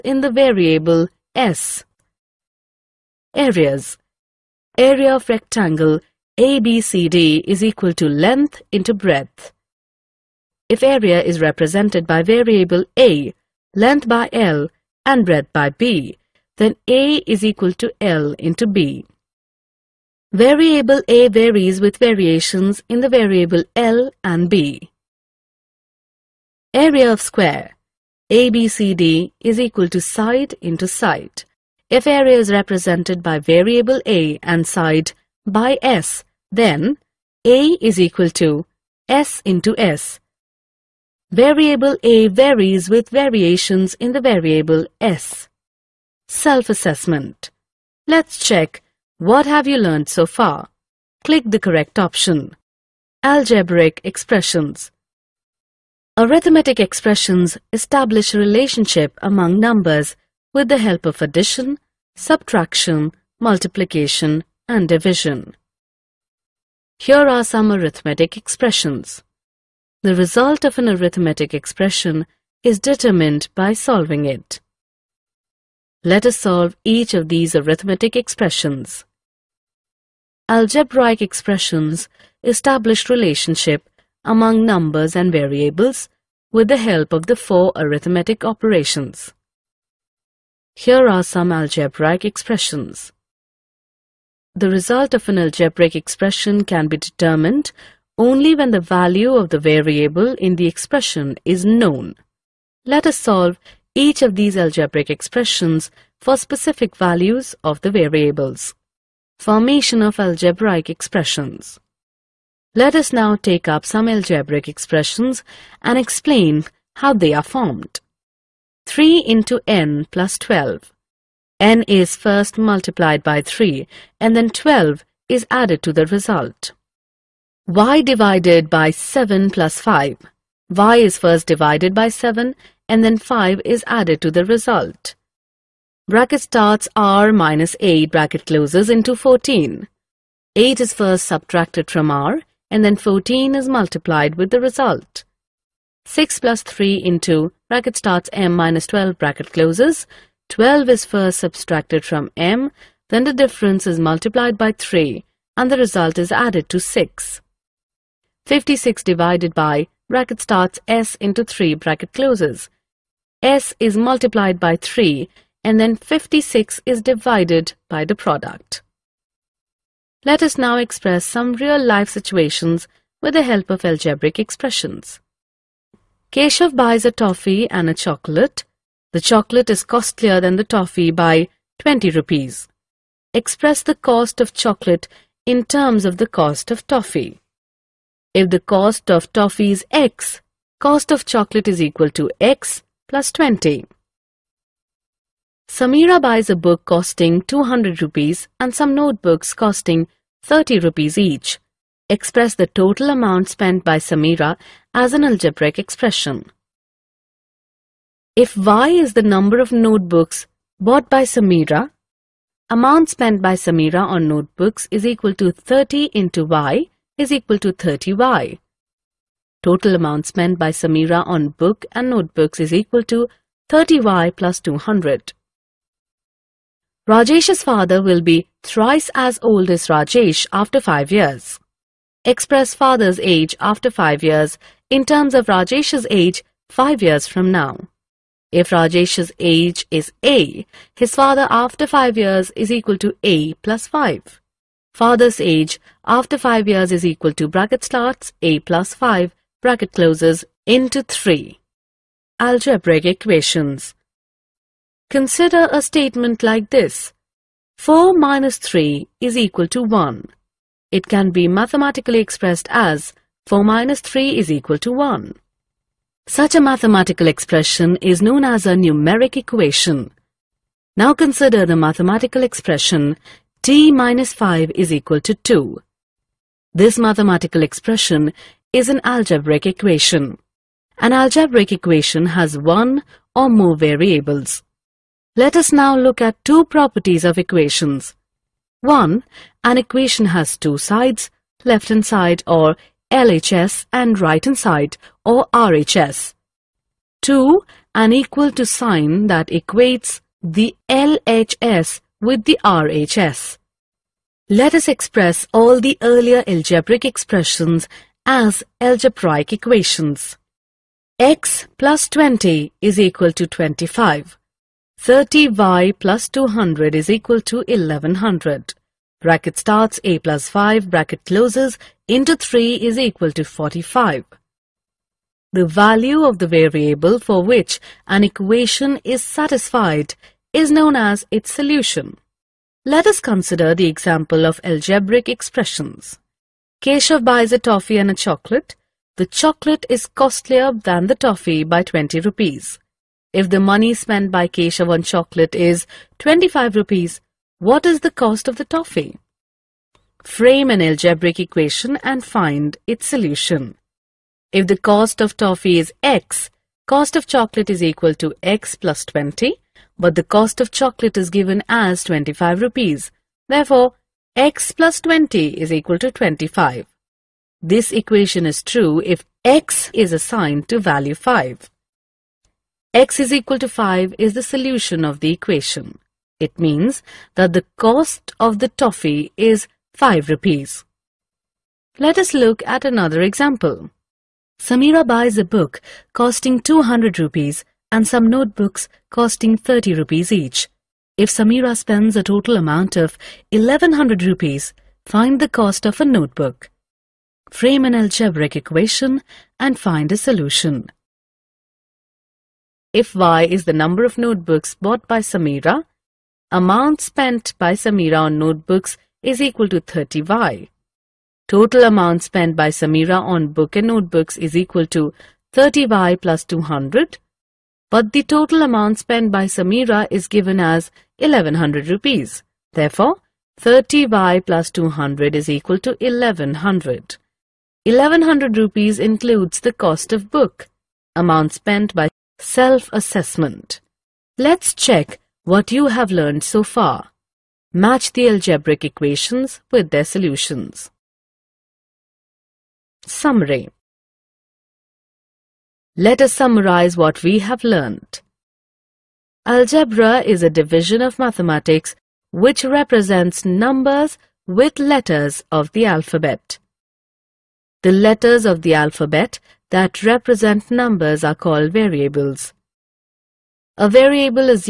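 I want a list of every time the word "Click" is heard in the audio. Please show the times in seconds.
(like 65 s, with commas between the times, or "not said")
51 s.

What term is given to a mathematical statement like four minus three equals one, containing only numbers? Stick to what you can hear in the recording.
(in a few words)
numeric equation.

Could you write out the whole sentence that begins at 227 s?
Rajesh's father will be thrice as old as Rajesh after 5 years.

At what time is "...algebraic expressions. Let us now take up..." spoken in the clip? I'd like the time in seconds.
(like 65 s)
110 s.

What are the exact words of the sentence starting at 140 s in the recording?
8 is first subtracted from r and then 14 is multiplied with the result.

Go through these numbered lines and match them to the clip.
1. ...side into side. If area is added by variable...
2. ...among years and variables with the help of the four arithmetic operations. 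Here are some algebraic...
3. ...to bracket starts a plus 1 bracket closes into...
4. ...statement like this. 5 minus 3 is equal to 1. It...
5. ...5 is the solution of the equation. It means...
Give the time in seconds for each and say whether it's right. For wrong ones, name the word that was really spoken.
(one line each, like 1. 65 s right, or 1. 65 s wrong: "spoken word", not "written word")
1. 30 s wrong: "represented", not "added"
2. 84 s wrong: "numbers", not "years"
3. 247 s wrong: "5", not "1"
4. 255 s wrong: "4", not "5"
5. 373 s right.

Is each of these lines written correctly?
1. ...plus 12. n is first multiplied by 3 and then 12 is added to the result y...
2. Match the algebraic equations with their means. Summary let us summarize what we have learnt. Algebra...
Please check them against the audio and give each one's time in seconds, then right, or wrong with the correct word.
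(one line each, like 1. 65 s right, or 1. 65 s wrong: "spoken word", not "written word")
1. 120 s right
2. 437 s wrong: "solutions", not "means".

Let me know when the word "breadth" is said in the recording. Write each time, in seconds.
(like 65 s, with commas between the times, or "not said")
8 s, 15 s.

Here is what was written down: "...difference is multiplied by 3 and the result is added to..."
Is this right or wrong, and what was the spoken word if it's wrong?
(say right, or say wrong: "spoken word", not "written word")
right.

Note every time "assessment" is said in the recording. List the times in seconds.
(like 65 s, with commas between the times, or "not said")
46 s, 432 s.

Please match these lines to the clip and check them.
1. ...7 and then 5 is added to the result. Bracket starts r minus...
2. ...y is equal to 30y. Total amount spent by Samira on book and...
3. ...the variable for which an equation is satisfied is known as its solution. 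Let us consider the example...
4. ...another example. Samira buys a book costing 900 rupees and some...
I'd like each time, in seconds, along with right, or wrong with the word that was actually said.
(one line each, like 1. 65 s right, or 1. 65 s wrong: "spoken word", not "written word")
1. 132 s right
2. 216 s right
3. 326 s right
4. 382 s wrong: "200", not "900".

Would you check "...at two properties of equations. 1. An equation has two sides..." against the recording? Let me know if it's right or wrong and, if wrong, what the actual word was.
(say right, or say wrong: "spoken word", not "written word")
right.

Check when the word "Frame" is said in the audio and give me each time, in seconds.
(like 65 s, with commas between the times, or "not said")
350 s, 397 s.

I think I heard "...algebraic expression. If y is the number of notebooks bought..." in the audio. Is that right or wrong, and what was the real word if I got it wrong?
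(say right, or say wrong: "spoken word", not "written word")
right.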